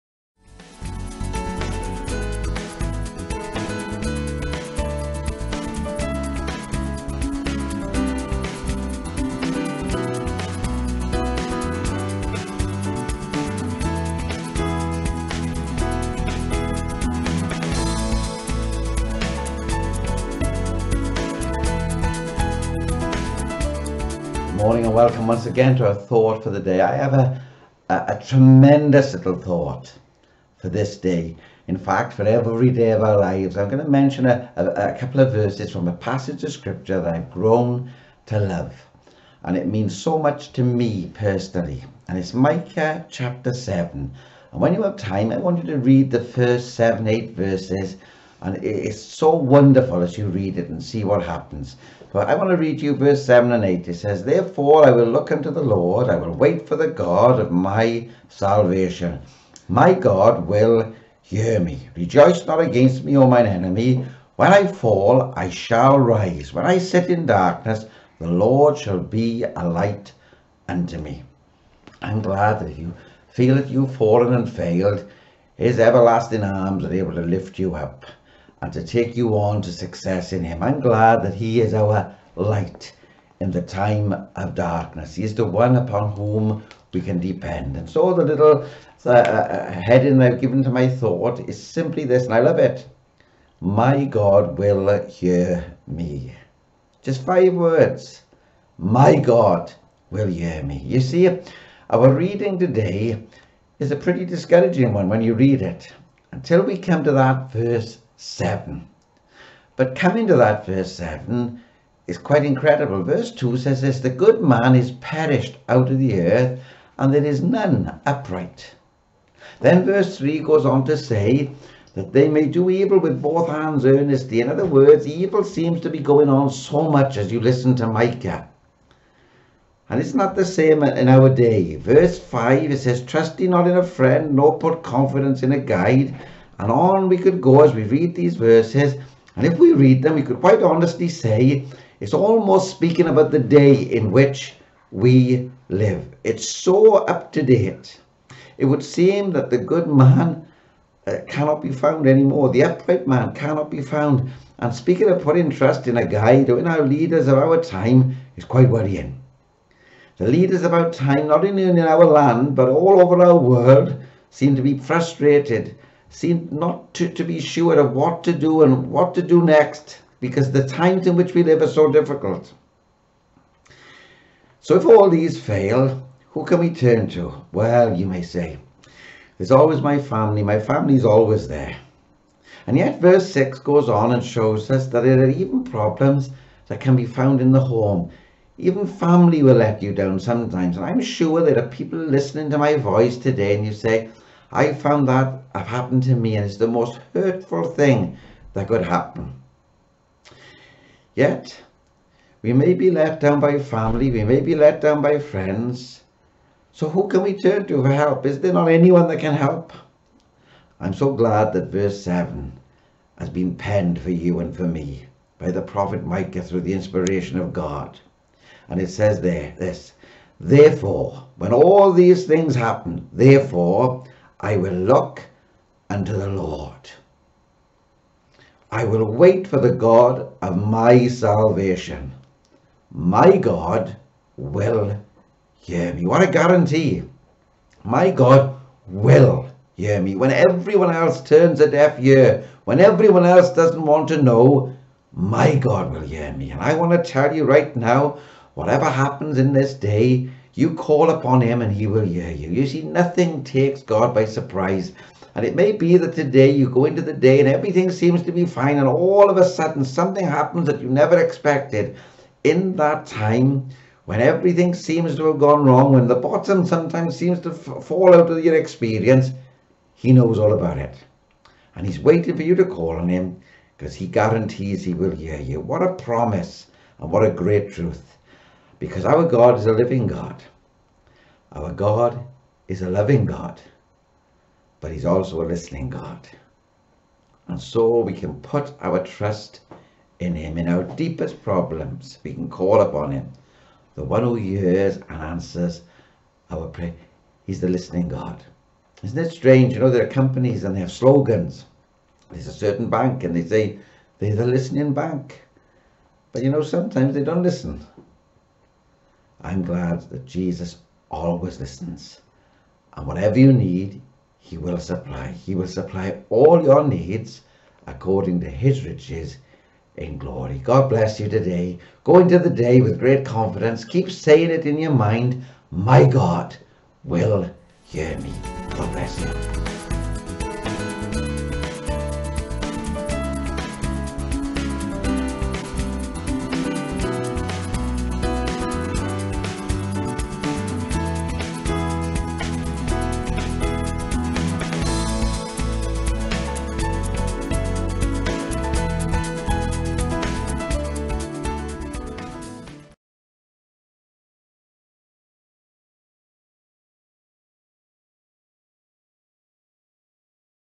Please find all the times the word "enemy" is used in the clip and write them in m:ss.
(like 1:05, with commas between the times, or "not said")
1:03.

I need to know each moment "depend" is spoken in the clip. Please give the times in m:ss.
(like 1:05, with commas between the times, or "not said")
1:27.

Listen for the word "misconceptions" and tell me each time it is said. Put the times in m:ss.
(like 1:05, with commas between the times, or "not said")
not said.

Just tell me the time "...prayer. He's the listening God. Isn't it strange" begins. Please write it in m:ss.
4:56.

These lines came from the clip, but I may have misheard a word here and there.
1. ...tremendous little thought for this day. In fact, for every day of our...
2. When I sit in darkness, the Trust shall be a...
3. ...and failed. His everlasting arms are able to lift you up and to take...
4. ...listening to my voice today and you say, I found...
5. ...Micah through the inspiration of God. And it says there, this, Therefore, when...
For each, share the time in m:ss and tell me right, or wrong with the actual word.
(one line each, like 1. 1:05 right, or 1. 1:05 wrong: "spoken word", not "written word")
1. 0:28 right
2. 1:06 wrong: "Lord", not "Trust"
3. 1:14 right
4. 3:11 right
5. 3:36 right.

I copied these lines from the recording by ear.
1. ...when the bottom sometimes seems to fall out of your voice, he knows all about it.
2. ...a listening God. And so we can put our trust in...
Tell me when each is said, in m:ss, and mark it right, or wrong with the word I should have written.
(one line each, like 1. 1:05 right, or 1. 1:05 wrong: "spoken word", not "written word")
1. 4:25 wrong: "experience", not "voice"
2. 4:45 right.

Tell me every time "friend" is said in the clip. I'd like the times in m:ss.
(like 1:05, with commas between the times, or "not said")
2:13, 3:25.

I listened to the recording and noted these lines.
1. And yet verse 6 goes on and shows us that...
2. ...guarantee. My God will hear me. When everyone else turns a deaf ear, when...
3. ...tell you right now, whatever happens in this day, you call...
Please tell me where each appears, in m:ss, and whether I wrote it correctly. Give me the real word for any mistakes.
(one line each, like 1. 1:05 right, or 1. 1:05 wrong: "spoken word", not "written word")
1. 3:02 right
2. 3:56 right
3. 4:07 right.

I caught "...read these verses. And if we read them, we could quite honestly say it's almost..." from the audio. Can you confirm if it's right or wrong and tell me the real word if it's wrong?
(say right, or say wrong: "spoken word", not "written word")
right.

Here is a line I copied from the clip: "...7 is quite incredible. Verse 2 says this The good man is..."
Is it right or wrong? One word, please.
right.